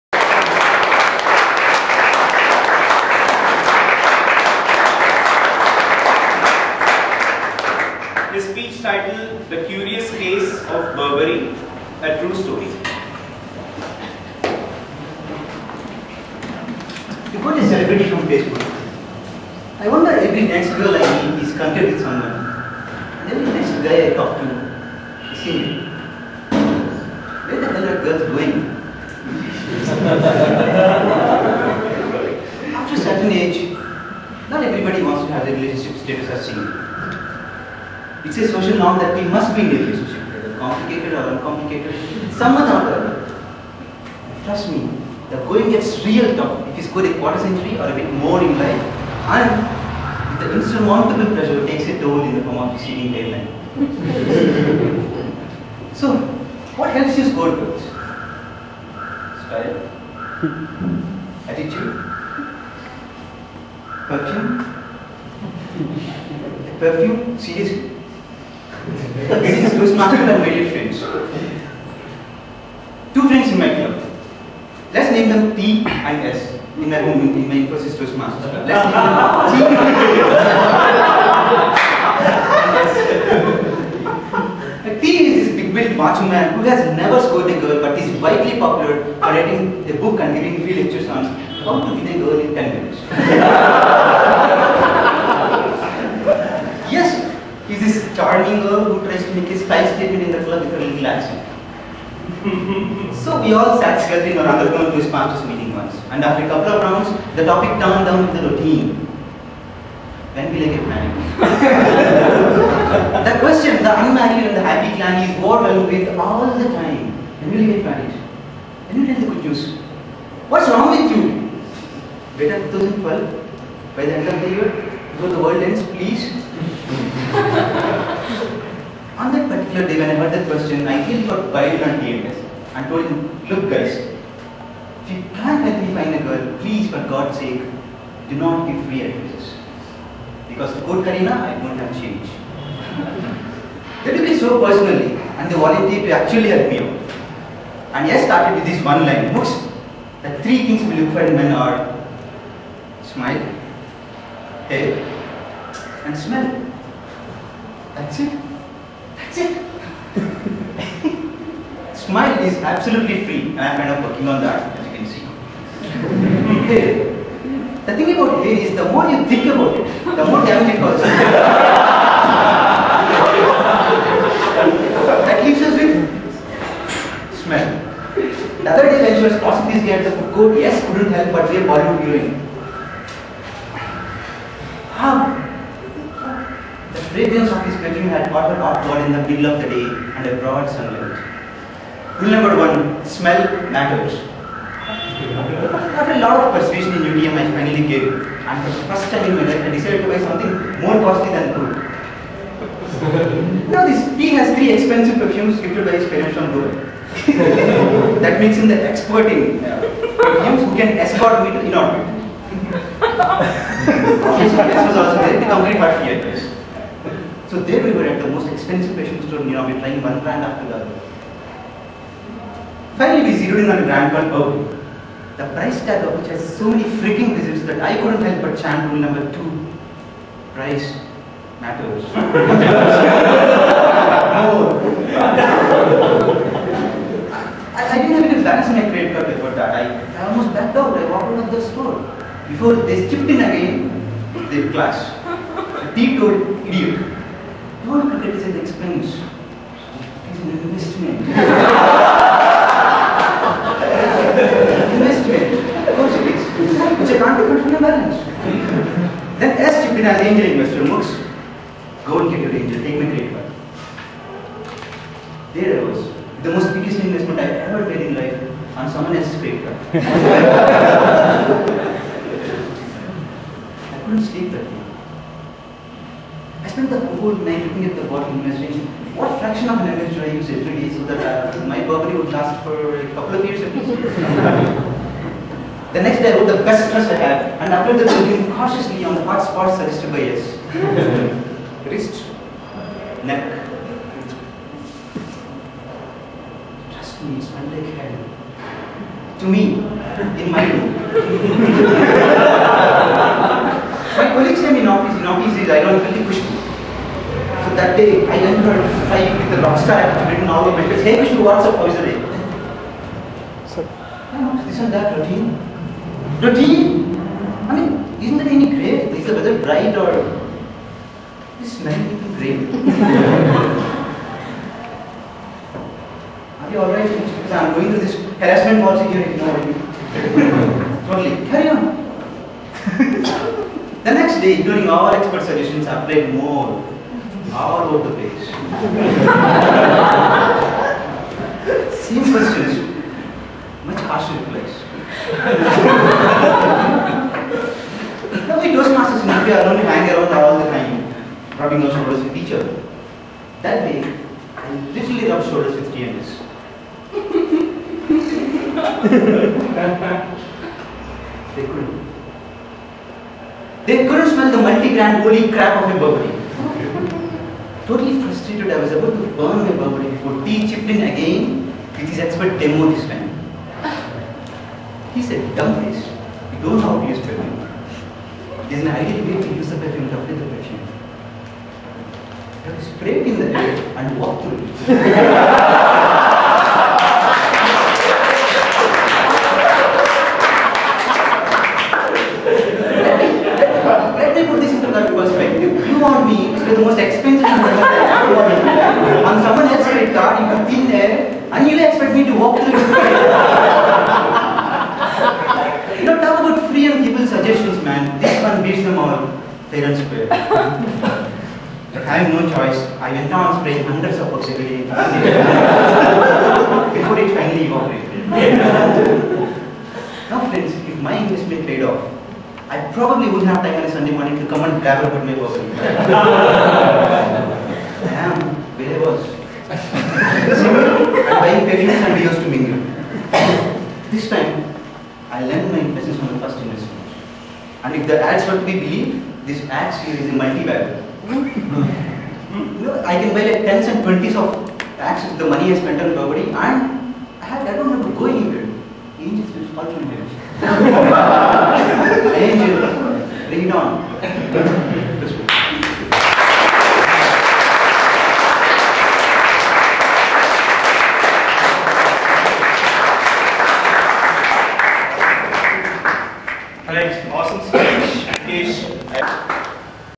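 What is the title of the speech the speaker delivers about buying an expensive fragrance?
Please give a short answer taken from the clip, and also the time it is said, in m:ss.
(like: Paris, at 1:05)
The Curious Case of Burberry, at 0:09.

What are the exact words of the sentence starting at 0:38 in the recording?
It's a social norm that we must be in a relationship, whether complicated or uncomplicated, somehow or other.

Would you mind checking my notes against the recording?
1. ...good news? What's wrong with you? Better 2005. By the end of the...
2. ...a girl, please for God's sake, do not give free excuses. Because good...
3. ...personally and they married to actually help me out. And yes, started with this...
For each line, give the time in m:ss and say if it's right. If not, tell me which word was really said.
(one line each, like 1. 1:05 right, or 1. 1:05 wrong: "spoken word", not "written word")
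1. 1:59 wrong: "2012", not "2005"
2. 2:16 right
3. 2:24 wrong: "volunteered", not "married".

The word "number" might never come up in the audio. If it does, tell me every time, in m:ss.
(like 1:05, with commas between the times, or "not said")
3:12, 3:49.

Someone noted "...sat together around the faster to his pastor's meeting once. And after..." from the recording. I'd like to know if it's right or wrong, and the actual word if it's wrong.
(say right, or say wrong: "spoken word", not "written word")
wrong: "corner", not "faster".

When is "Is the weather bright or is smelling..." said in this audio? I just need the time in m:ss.
5:19.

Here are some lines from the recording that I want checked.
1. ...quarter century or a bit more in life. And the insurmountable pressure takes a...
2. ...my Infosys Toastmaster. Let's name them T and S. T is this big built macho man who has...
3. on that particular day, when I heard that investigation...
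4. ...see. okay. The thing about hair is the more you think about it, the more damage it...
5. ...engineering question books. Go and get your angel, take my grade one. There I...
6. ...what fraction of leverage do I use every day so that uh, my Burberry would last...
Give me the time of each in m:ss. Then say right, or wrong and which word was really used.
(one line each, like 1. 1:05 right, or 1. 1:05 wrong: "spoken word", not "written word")
1. 0:47 right
2. 1:17 right
3. 2:09 wrong: "question", not "investigation"
4. 2:45 right
5. 4:20 right
6. 4:39 right.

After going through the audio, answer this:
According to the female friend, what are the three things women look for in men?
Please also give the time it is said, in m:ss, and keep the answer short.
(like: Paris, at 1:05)
Smile, hair, and smell, at 2:33.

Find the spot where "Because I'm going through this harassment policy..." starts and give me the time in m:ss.
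5:27.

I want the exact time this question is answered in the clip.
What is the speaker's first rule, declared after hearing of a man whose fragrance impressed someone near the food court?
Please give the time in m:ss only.
3:13.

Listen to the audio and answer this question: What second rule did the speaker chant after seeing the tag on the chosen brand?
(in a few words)
Price matters.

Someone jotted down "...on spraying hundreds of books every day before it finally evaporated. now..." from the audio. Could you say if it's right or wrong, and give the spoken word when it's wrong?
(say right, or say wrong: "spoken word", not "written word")
right.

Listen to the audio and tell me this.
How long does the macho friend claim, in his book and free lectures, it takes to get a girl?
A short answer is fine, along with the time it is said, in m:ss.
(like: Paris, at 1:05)
10 minutes, at 1:32.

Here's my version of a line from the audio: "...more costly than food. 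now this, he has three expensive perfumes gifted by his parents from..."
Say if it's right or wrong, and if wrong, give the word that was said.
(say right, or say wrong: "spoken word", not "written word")
right.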